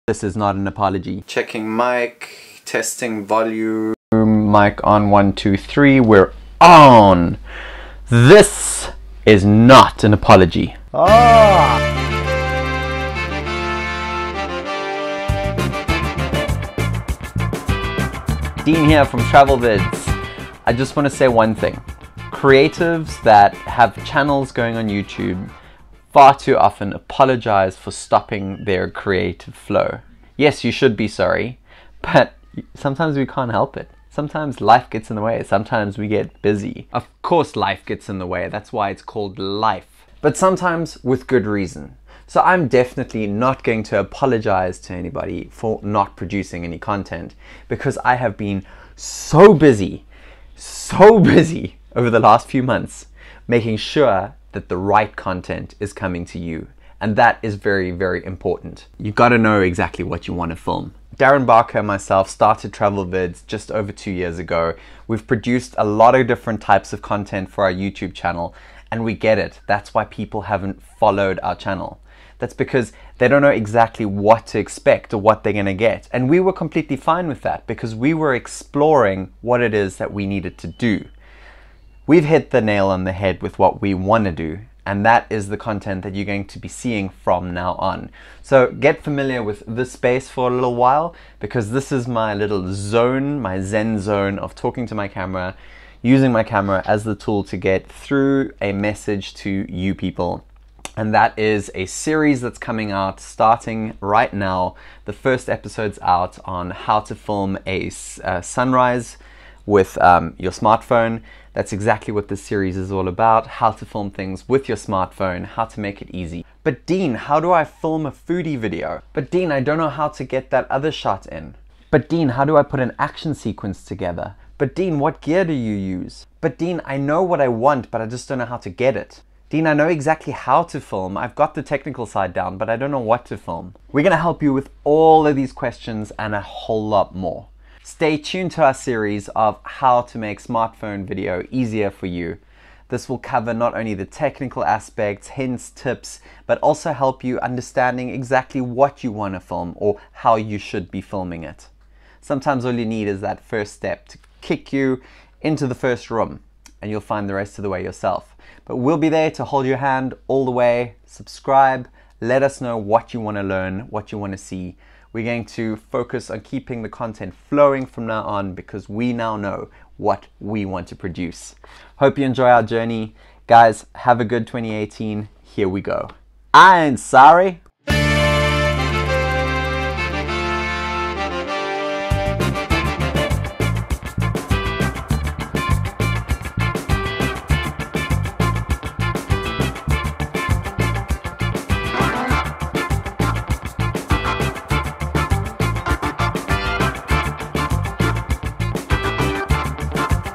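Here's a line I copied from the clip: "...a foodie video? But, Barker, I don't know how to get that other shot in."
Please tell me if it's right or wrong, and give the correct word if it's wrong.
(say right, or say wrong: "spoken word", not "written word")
wrong: "Dean", not "Barker".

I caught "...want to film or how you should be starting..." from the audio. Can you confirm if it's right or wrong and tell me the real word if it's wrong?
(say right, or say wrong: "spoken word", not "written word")
wrong: "filming", not "starting".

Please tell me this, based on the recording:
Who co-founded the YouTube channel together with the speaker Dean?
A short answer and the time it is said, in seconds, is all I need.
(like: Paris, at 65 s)
Darren Barker, at 61 s.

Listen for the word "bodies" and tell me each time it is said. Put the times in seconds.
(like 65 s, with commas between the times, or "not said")
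not said.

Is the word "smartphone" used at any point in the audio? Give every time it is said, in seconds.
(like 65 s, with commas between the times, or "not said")
110 s, 114 s, 140 s.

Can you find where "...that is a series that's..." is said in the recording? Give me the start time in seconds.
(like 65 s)
101 s.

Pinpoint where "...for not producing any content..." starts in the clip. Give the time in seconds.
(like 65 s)
45 s.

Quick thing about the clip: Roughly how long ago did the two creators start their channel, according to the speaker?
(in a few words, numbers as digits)
Just over 2 years.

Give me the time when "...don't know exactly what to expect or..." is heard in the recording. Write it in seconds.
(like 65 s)
73 s.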